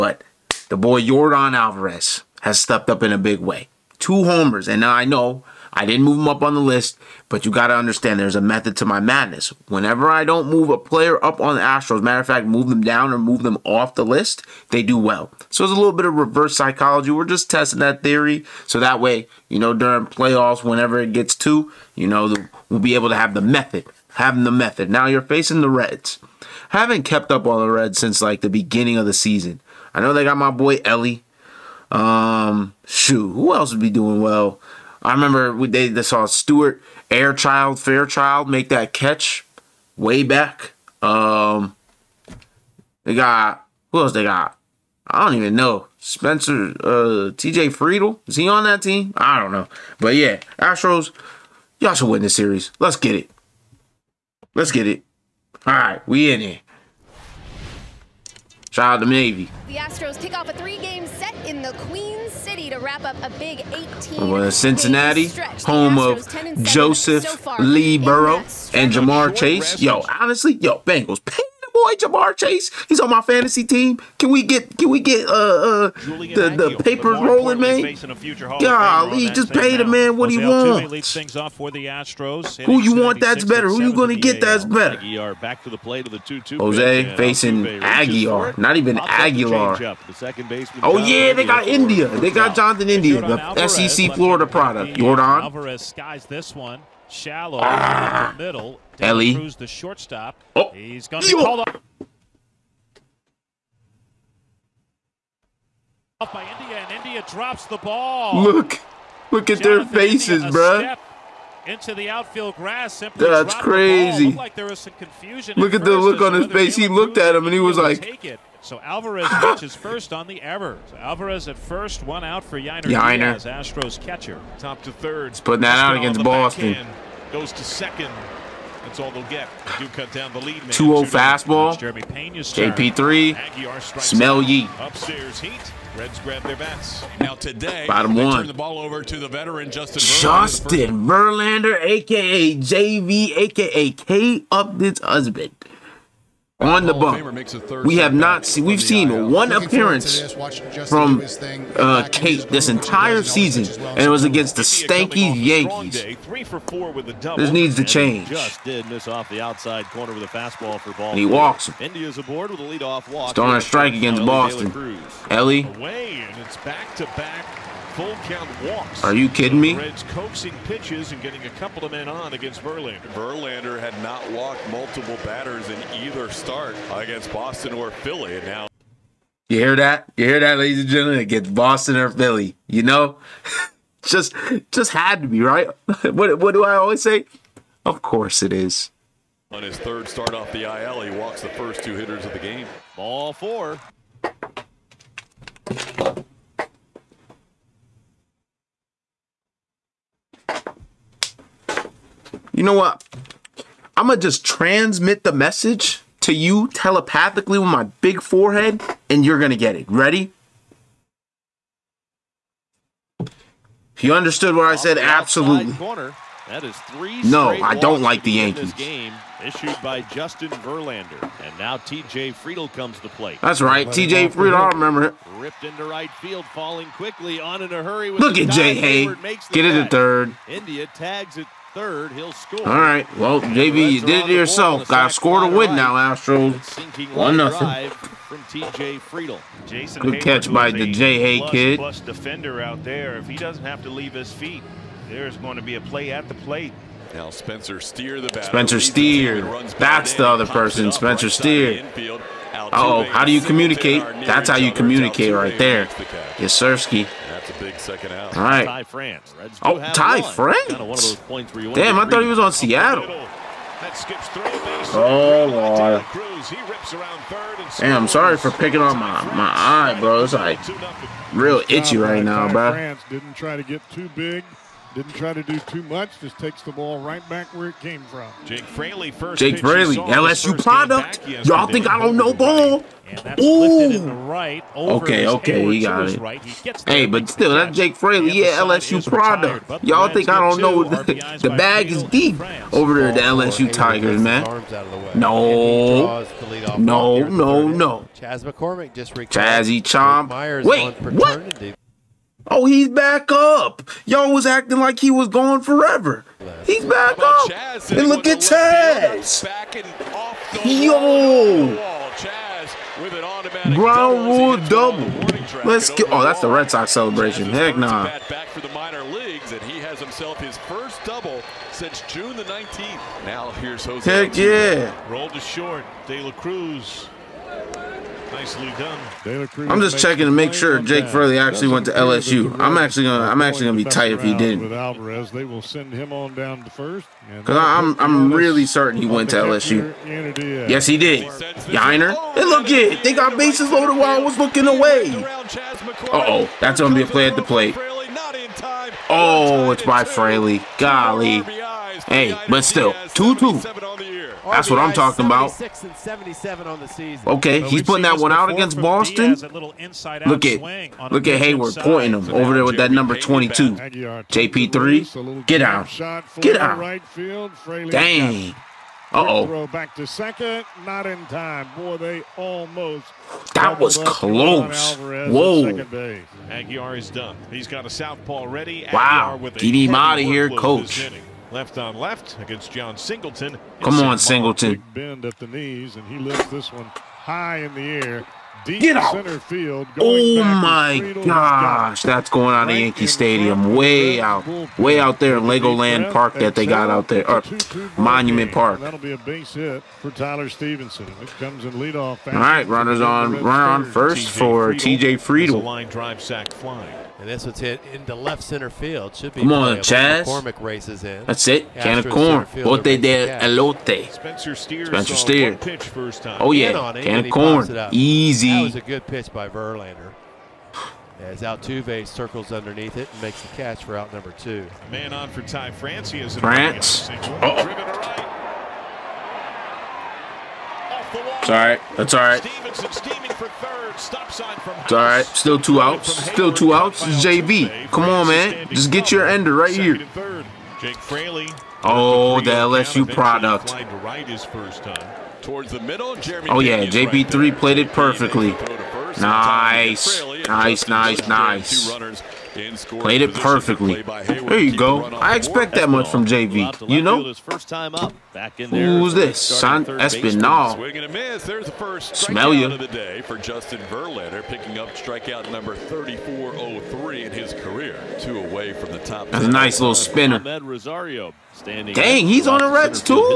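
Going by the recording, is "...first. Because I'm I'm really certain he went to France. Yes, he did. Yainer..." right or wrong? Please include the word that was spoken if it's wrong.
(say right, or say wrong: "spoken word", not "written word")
wrong: "LSU", not "France".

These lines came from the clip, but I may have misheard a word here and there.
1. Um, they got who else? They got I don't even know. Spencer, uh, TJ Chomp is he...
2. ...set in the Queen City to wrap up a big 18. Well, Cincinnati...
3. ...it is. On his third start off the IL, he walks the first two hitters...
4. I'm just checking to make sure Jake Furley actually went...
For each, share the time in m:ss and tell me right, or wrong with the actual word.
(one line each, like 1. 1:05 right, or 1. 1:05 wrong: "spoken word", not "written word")
1. 0:41 wrong: "Friedl", not "Chomp"
2. 1:01 right
3. 3:08 right
4. 5:29 right.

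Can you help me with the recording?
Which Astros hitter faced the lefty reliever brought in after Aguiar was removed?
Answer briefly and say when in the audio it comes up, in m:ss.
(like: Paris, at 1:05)
Jon Singleton, at 6:22.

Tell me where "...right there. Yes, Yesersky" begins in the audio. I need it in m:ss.
4:15.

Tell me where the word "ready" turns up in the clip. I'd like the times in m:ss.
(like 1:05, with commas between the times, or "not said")
3:29, 6:18.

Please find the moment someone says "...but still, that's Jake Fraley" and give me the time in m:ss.
4:47.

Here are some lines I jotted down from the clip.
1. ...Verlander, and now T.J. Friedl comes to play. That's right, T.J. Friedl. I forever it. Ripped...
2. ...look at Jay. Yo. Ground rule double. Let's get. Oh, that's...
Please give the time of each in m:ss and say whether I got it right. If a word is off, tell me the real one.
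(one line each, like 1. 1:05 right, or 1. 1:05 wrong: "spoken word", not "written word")
1. 3:40 wrong: "remember", not "forever"
2. 5:08 wrong: "Chas", not "Jay".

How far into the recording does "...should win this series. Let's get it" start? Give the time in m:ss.
0:51.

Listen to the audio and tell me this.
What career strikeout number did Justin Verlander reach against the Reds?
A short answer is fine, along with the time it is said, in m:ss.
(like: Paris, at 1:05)
3403, at 7:45.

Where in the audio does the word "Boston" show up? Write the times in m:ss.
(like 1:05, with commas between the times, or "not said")
2:06, 2:44, 2:57, 3:01, 5:58.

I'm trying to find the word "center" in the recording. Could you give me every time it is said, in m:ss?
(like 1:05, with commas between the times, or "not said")
6:29, 6:48.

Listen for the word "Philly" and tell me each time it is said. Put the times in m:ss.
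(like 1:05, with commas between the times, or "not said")
2:57, 3:02.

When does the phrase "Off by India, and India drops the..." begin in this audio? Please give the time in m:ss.
1:46.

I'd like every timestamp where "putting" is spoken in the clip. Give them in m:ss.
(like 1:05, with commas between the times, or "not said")
2:05, 5:57.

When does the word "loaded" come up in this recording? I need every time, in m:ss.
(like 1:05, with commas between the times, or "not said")
5:43.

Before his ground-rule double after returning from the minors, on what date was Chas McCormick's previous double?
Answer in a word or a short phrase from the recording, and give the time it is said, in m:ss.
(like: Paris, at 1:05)
June 19th, at 5:22.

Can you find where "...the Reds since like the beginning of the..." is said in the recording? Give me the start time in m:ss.
0:27.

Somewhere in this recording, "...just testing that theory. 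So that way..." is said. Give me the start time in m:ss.
0:17.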